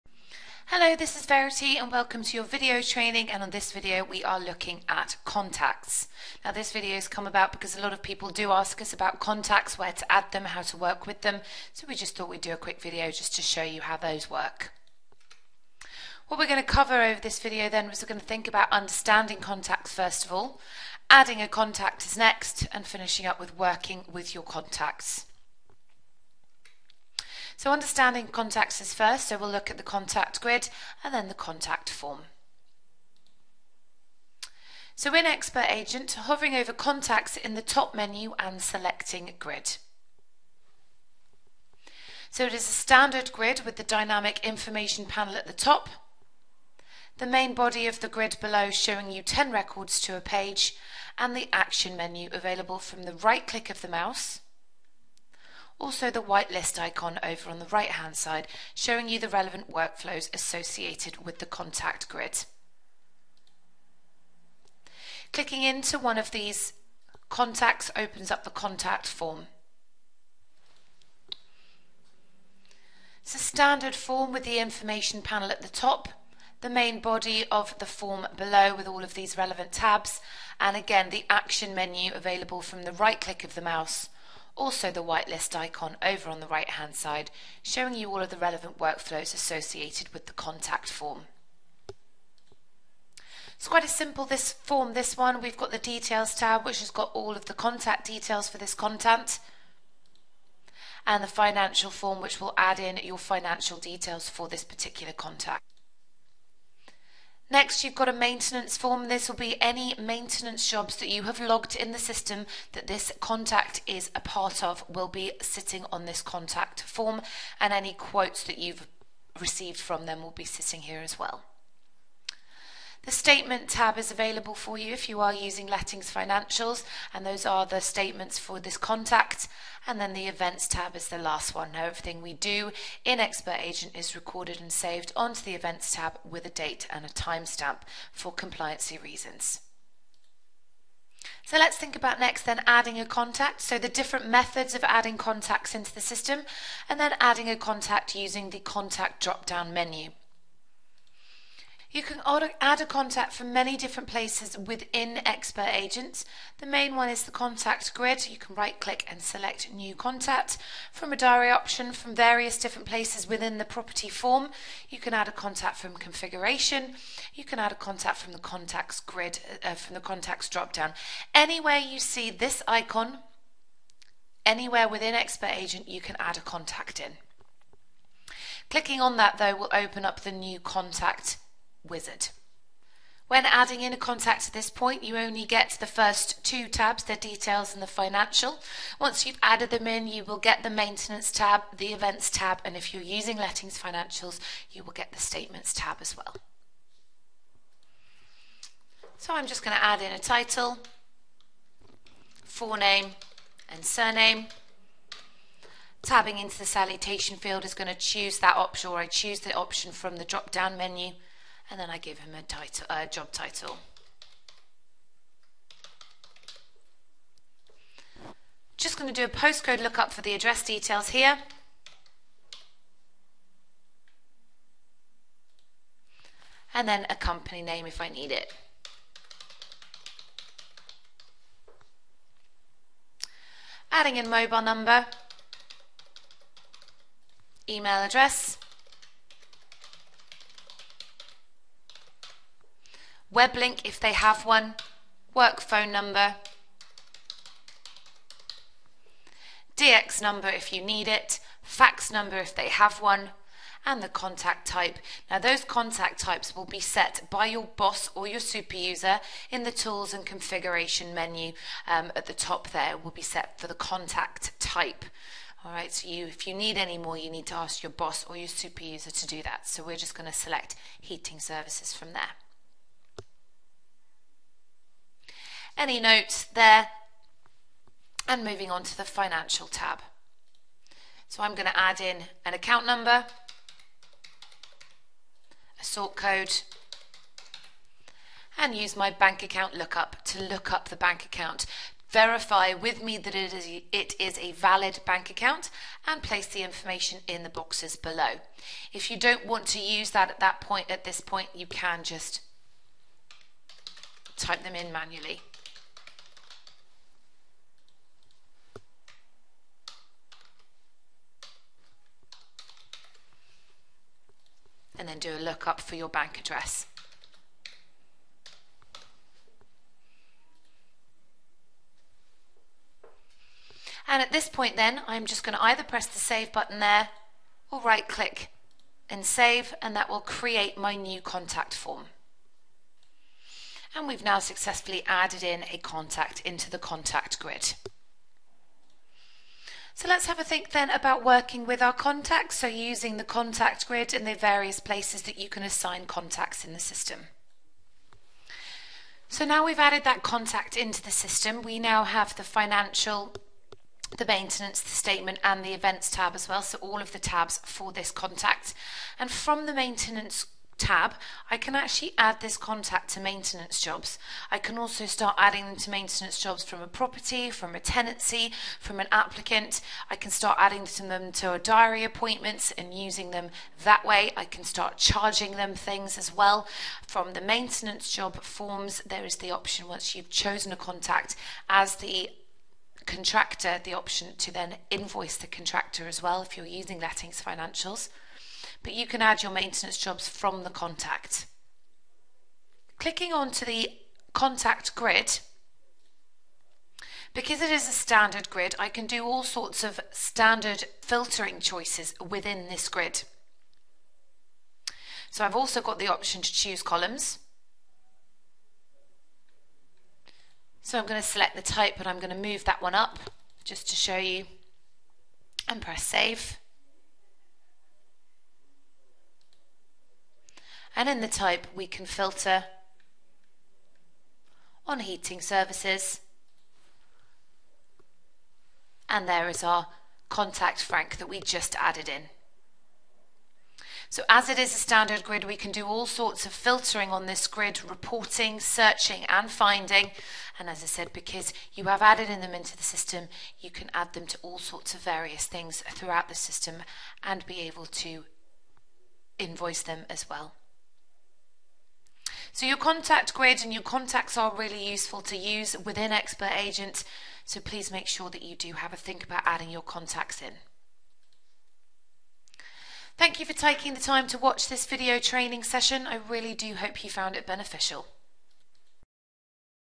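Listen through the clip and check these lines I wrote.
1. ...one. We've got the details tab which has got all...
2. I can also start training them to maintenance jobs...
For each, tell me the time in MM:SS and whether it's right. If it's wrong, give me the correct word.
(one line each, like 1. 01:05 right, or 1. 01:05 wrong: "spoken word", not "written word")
1. 01:35 right
2. 06:04 wrong: "adding", not "training".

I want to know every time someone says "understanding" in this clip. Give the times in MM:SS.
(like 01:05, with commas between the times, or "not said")
00:18, 00:27.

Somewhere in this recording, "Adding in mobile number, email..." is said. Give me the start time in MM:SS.
03:53.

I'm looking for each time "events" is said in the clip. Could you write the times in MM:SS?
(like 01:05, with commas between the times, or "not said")
02:10, 02:15, 03:11, 05:55.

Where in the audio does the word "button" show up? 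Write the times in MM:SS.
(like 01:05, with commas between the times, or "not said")
05:26.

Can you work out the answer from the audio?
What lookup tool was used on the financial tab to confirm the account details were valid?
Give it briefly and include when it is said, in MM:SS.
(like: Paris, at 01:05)
Bank account lookup, at 04:49.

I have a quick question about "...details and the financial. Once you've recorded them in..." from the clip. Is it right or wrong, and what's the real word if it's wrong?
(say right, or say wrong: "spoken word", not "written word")
wrong: "added", not "recorded".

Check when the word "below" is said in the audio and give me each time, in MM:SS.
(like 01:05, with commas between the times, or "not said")
00:48, 01:18, 04:57.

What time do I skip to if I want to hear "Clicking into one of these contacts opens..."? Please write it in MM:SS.
01:05.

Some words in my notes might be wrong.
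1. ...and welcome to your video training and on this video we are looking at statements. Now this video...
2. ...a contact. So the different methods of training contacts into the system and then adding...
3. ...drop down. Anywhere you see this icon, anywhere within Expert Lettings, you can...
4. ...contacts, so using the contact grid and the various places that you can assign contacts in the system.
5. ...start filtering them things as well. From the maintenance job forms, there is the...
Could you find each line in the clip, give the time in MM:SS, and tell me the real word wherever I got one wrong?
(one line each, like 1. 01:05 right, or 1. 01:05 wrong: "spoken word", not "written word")
1. 00:01 wrong: "contacts", not "statements"
2. 02:22 wrong: "adding", not "training"
3. 02:50 wrong: "Agent", not "Lettings"
4. 05:41 right
5. 06:14 wrong: "charging", not "filtering".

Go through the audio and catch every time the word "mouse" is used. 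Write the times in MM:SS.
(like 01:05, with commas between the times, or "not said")
00:53, 01:23.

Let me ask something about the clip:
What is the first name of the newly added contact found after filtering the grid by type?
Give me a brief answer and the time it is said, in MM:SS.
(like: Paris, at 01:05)
Frank, at 07:10.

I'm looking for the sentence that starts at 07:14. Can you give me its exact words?
So as it is a standard grid, we can do all sorts of filtering on this grid, reporting, searching and finding.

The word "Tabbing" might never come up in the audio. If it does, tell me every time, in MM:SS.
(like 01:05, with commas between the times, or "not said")
03:26.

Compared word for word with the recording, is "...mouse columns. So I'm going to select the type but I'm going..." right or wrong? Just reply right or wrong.
wrong.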